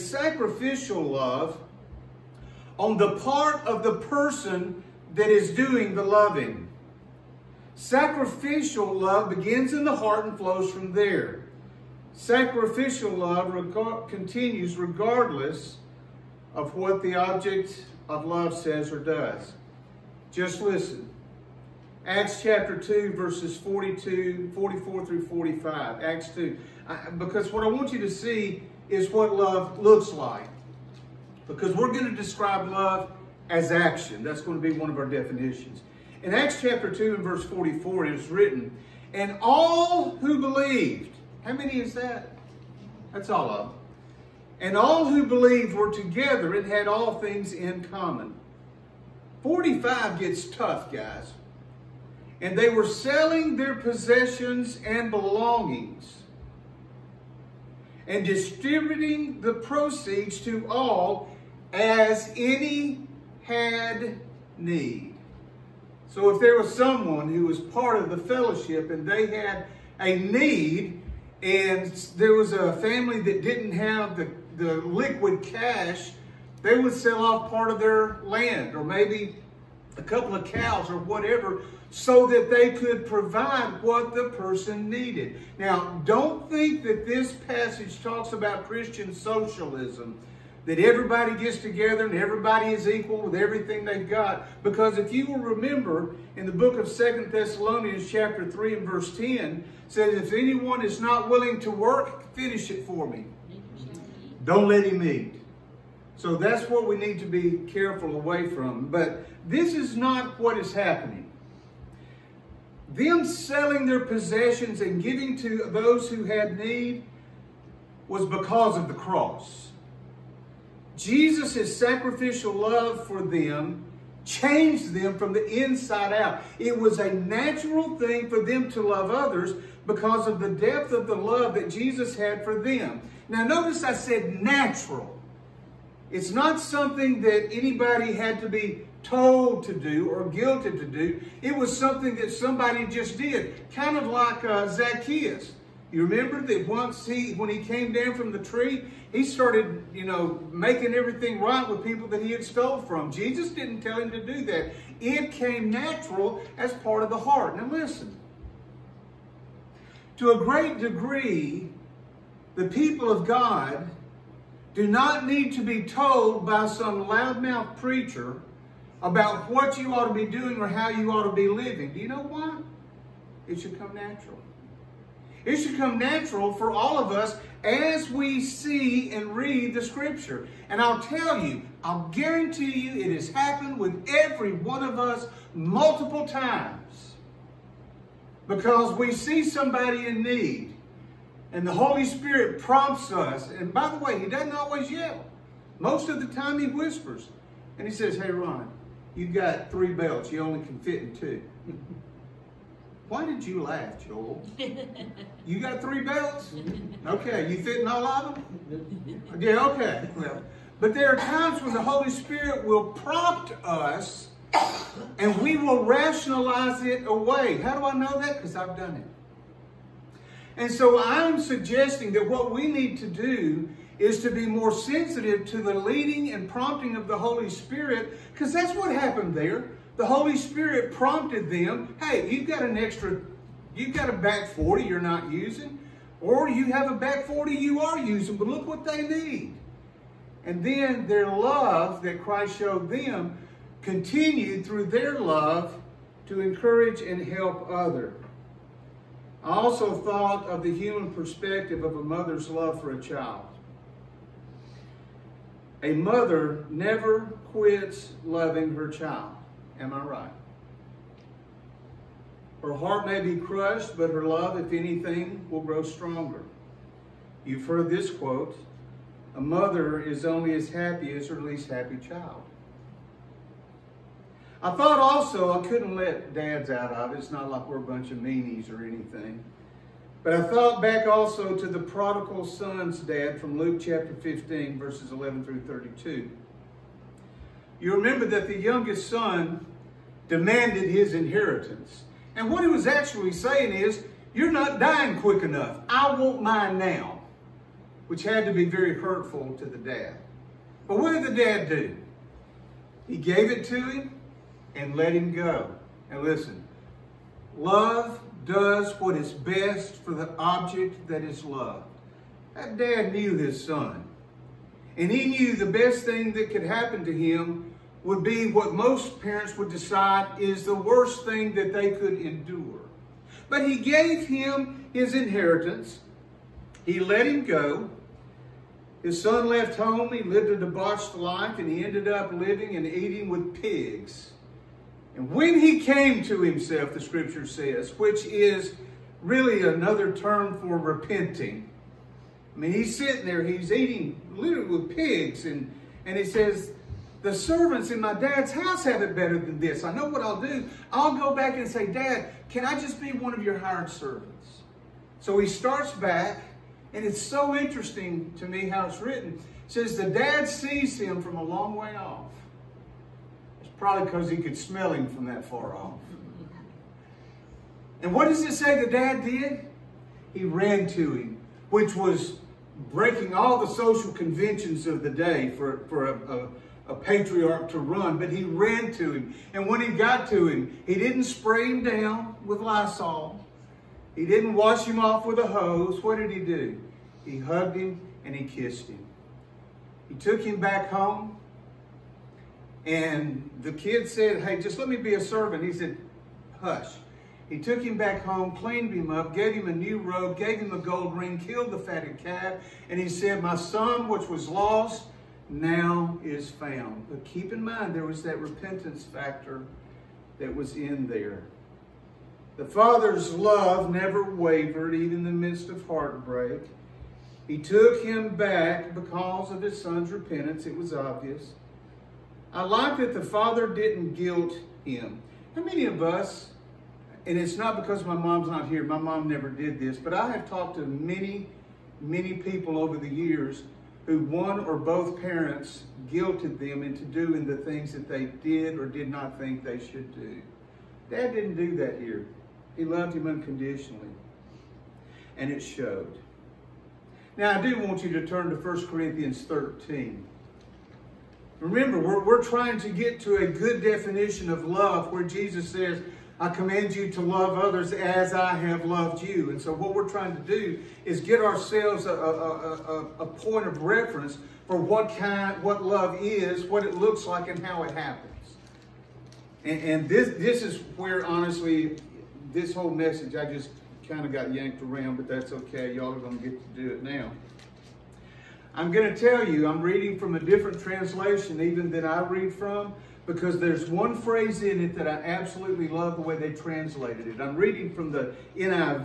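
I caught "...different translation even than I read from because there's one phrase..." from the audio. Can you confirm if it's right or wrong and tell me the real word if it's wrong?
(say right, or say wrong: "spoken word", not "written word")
right.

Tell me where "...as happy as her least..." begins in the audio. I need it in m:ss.
4:30.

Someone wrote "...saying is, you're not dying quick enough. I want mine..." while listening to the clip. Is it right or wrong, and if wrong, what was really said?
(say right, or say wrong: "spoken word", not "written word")
right.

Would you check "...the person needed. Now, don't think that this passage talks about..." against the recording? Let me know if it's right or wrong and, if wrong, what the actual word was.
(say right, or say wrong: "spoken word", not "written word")
right.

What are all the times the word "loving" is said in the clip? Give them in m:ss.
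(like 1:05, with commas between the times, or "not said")
0:06, 4:18.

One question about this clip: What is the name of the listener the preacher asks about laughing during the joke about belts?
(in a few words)
Joel.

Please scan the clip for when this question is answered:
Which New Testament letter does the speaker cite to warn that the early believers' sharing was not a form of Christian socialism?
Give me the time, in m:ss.
1:36.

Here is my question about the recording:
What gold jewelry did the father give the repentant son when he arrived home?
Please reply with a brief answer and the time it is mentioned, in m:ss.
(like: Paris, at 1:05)
A gold ring, at 6:40.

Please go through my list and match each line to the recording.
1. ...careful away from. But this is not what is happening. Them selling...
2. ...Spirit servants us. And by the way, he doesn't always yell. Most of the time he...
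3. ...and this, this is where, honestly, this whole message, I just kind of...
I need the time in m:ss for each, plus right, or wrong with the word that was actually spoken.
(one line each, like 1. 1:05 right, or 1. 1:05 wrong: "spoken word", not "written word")
1. 1:47 right
2. 3:12 wrong: "prompts", not "servants"
3. 7:49 right.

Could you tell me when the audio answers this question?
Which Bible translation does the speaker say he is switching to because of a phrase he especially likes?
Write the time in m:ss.
8:08.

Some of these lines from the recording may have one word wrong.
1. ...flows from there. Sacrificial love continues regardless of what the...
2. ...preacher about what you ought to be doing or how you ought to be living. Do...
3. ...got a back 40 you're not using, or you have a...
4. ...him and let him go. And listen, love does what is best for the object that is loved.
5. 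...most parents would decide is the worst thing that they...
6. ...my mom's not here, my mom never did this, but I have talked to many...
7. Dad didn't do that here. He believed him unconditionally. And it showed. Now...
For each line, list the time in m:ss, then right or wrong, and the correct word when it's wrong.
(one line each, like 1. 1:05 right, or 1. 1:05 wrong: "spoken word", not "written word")
1. 0:10 right
2. 2:47 right
3. 3:53 right
4. 5:03 right
5. 5:18 right
6. 7:08 right
7. 7:21 wrong: "loved", not "believed".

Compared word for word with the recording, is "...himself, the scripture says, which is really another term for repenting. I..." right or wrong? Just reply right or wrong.
right.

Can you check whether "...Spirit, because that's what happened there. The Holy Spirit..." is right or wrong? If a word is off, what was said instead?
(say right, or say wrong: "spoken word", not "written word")
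right.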